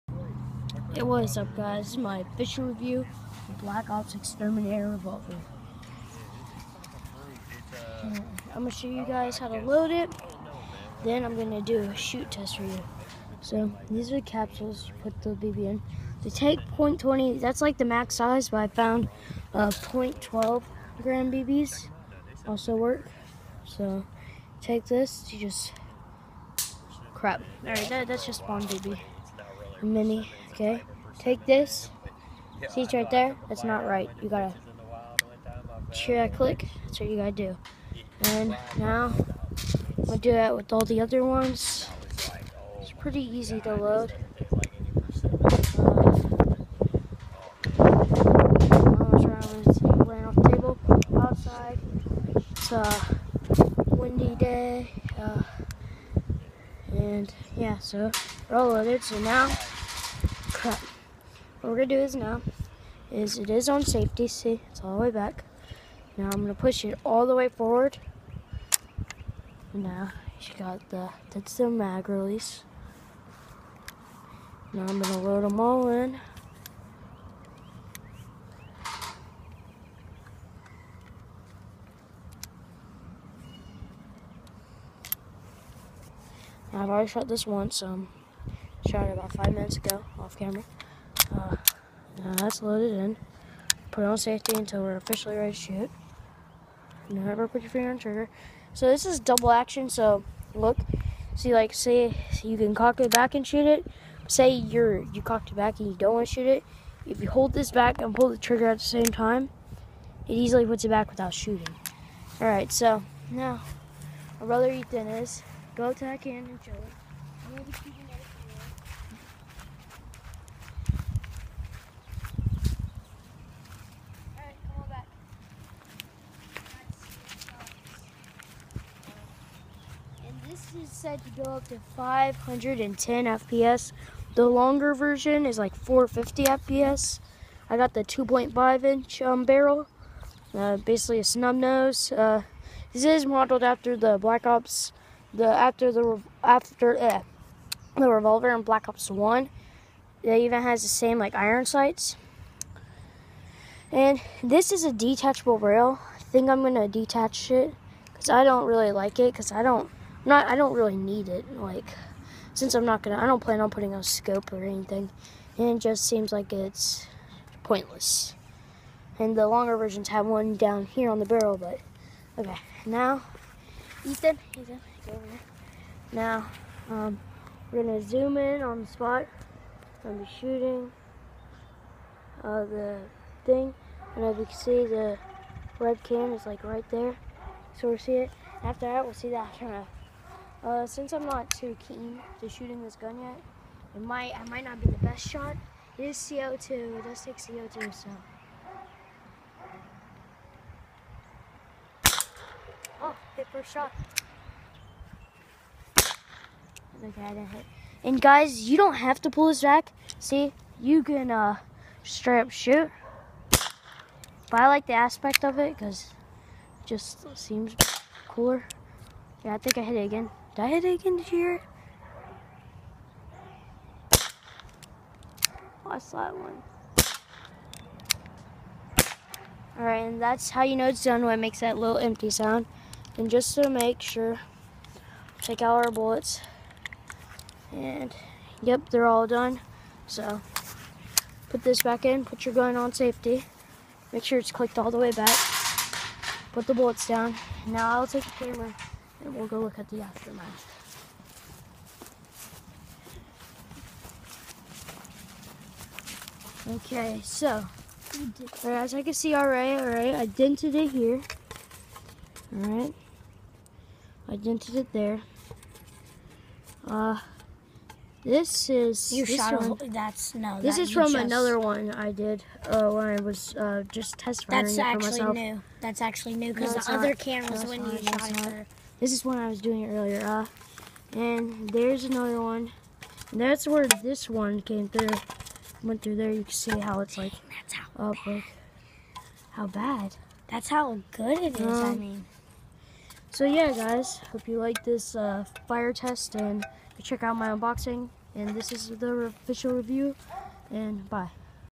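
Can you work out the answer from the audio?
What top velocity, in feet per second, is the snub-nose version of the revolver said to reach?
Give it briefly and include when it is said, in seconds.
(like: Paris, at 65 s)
510 FPS, at 131 s.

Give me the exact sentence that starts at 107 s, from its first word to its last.
If you hold this back and pull the trigger at the same time, it easily puts it back without shooting.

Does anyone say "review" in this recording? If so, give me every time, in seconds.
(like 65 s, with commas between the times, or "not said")
2 s, 299 s.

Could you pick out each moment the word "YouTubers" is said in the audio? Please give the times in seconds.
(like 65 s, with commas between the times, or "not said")
not said.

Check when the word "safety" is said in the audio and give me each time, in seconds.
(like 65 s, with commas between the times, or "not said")
63 s, 94 s, 242 s.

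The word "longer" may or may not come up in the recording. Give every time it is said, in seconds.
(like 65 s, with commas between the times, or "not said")
134 s, 169 s.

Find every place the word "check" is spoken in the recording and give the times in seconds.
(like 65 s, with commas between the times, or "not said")
35 s, 297 s.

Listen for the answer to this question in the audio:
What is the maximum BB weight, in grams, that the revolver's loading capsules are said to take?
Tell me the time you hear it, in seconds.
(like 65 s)
16 s.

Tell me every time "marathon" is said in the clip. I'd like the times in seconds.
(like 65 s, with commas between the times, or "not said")
not said.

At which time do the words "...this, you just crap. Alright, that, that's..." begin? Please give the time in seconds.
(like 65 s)
24 s.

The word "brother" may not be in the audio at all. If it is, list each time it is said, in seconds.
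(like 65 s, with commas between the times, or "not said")
114 s.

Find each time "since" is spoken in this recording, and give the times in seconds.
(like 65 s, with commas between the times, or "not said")
162 s, 190 s.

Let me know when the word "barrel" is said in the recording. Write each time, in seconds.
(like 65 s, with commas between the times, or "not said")
139 s, 171 s.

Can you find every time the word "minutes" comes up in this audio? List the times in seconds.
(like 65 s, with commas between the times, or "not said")
89 s.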